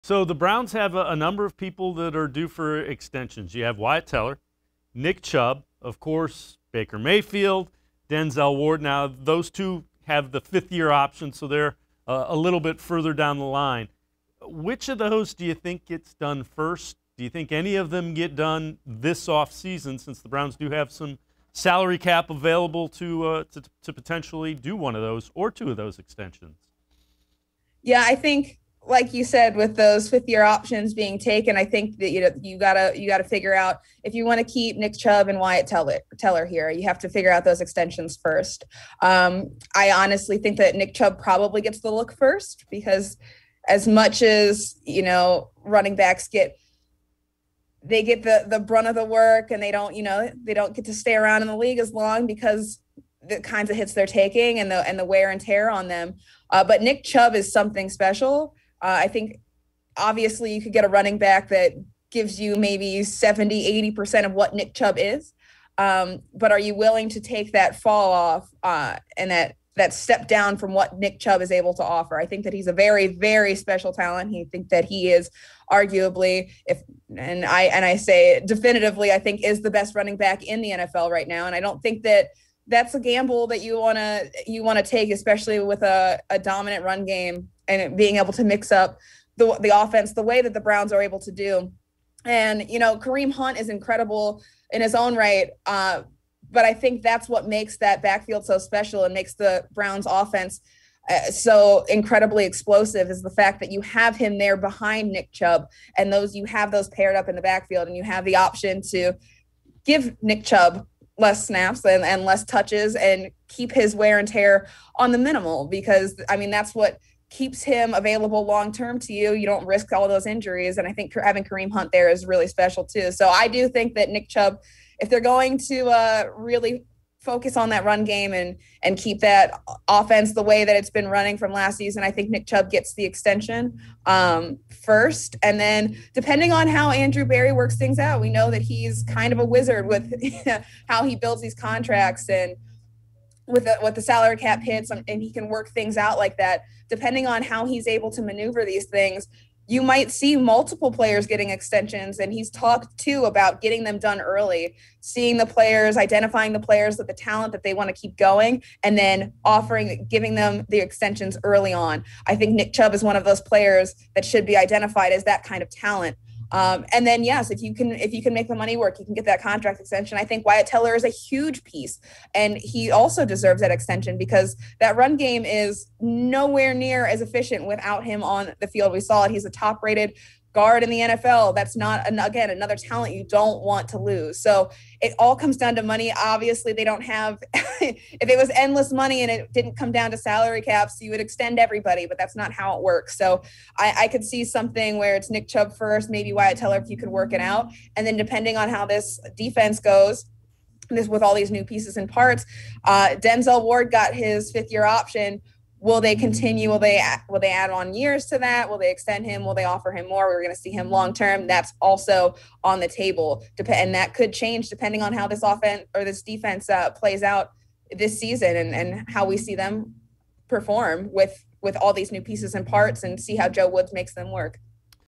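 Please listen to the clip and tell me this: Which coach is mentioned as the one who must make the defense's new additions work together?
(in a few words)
Joe Woods.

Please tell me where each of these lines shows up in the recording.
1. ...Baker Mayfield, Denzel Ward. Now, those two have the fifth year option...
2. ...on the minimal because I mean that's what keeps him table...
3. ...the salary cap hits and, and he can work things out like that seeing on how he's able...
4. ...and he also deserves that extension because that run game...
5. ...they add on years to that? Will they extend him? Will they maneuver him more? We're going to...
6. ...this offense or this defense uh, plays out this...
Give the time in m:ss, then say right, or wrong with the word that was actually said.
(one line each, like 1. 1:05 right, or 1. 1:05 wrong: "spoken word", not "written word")
1. 0:06 right
2. 1:54 wrong: "available", not "table"
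3. 2:23 wrong: "depending", not "seeing"
4. 2:52 right
5. 3:27 wrong: "offer", not "maneuver"
6. 3:35 right.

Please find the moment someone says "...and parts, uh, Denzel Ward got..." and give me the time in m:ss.
3:21.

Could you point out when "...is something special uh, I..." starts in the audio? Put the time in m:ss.
0:57.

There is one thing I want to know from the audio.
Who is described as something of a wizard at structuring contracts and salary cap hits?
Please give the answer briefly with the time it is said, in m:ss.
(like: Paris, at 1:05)
Andrew Berry, at 2:16.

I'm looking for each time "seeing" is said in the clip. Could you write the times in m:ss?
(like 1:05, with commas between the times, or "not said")
2:35.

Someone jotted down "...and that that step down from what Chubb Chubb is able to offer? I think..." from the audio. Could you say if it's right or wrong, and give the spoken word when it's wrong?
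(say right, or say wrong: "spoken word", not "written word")
wrong: "Nick", not "Chubb".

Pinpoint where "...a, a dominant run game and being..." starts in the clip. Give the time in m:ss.
1:25.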